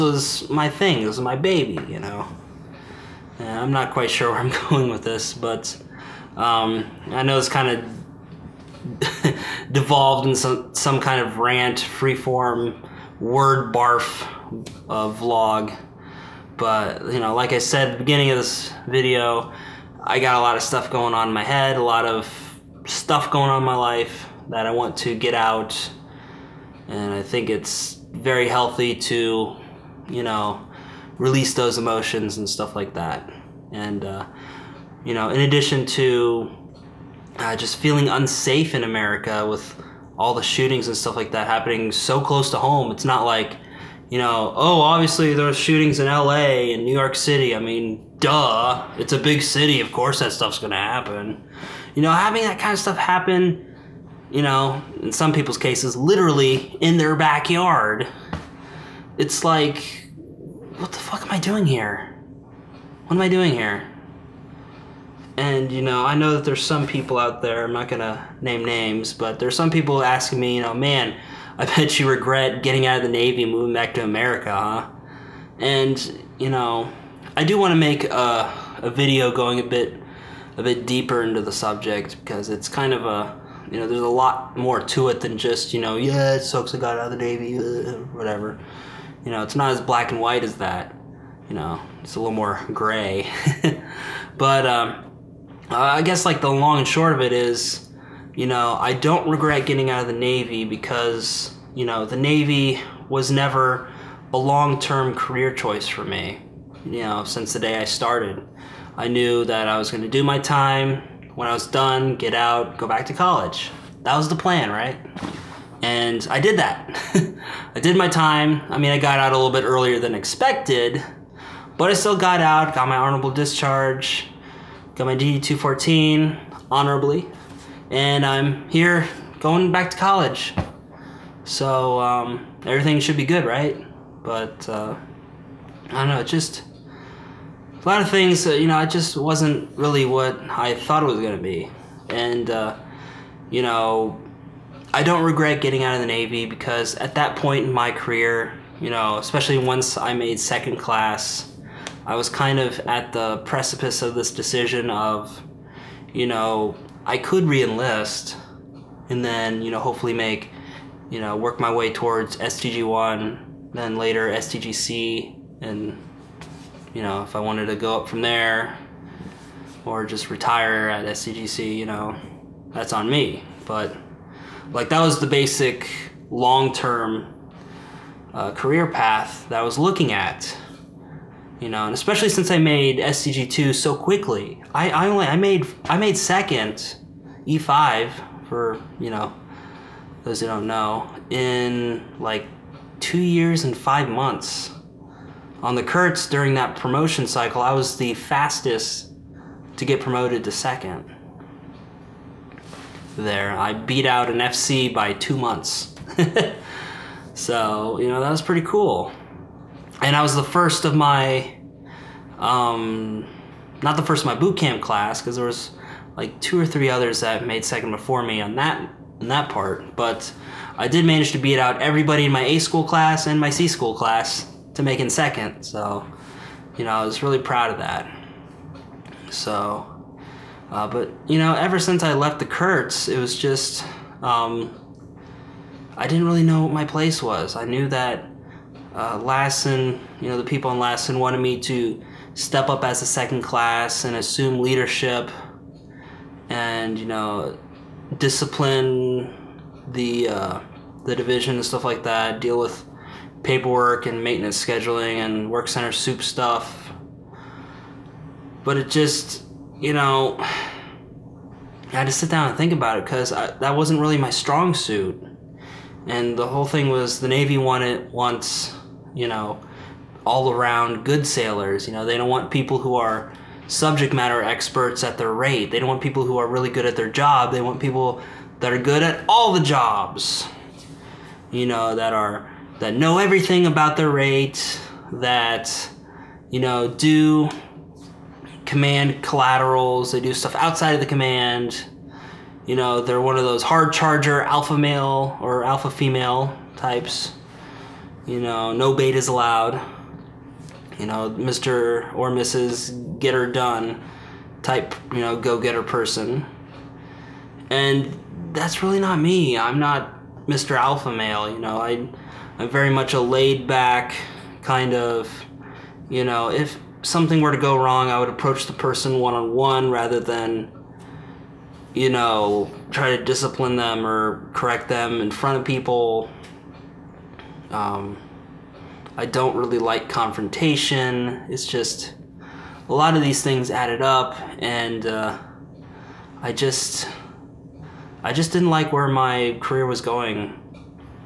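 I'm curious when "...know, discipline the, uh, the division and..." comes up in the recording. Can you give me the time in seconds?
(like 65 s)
247 s.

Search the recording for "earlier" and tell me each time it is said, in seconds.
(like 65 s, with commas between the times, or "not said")
119 s.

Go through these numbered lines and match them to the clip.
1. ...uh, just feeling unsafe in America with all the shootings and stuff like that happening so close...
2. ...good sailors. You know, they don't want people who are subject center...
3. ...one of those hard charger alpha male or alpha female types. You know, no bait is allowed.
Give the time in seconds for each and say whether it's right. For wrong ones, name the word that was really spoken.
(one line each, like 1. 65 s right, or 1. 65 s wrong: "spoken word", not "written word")
1. 37 s right
2. 271 s wrong: "matter", not "center"
3. 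293 s right.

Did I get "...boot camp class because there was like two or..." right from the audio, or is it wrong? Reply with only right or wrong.
right.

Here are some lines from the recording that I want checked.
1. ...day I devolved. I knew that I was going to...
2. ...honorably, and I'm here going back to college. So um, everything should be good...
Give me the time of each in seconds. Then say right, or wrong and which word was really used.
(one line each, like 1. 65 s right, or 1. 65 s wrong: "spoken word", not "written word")
1. 107 s wrong: "started", not "devolved"
2. 126 s right.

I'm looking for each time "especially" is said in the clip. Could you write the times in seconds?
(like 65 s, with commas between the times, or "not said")
149 s, 181 s.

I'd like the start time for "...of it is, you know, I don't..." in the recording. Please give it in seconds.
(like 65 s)
97 s.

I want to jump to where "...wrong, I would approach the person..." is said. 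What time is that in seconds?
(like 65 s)
317 s.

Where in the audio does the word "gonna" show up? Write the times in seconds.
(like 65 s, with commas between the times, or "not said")
67 s, 141 s.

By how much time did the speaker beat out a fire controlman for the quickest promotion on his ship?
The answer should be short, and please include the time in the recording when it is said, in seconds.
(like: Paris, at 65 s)
2 months, at 205 s.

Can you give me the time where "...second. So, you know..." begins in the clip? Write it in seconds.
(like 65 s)
225 s.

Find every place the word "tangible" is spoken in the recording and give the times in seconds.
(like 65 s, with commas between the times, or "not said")
not said.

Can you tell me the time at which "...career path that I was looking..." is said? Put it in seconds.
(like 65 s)
178 s.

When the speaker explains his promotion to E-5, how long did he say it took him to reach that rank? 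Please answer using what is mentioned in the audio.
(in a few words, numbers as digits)
2 years and 5 months.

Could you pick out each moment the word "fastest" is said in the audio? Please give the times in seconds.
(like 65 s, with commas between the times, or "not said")
198 s.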